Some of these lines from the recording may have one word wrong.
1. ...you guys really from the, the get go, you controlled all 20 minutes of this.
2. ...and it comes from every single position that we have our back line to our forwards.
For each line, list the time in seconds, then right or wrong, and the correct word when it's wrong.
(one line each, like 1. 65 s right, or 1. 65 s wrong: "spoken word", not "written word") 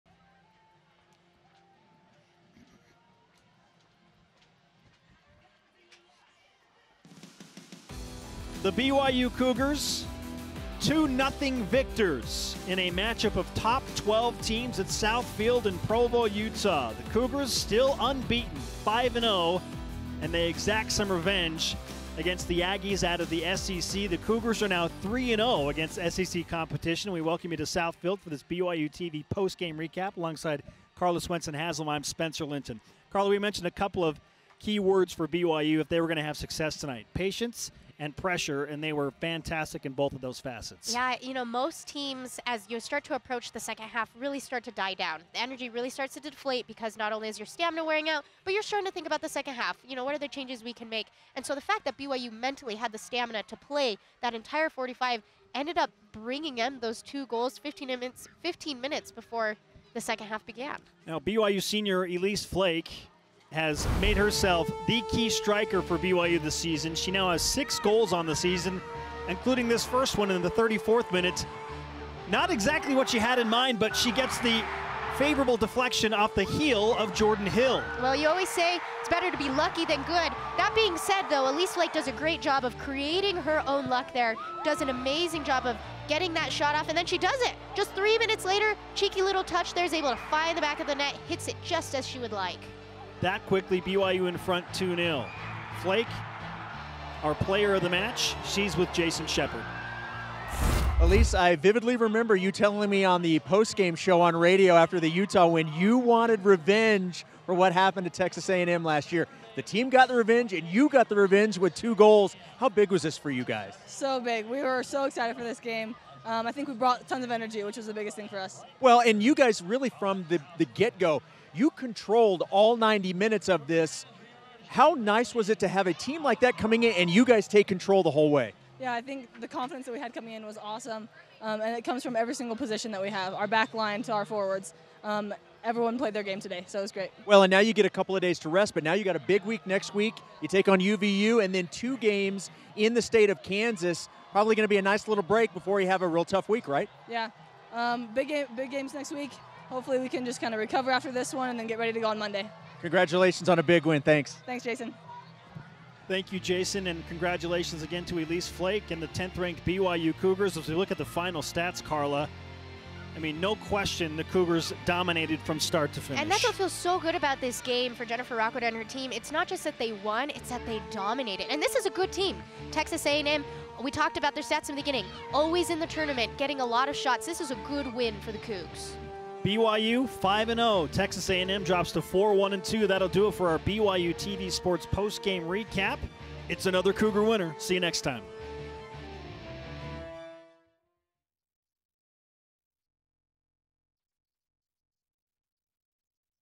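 1. 119 s wrong: "90", not "20"
2. 131 s right.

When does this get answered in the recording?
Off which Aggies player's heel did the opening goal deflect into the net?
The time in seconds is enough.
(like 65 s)
77 s.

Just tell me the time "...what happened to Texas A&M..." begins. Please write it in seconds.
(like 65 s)
107 s.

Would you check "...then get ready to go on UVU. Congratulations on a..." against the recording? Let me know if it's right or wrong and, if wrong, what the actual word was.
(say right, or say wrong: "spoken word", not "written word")
wrong: "Monday", not "UVU".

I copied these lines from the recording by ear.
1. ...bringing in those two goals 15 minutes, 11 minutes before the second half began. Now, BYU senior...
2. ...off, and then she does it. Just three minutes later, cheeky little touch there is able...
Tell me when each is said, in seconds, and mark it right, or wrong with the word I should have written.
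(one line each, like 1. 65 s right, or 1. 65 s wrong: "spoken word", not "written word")
1. 56 s wrong: "15", not "11"
2. 86 s right.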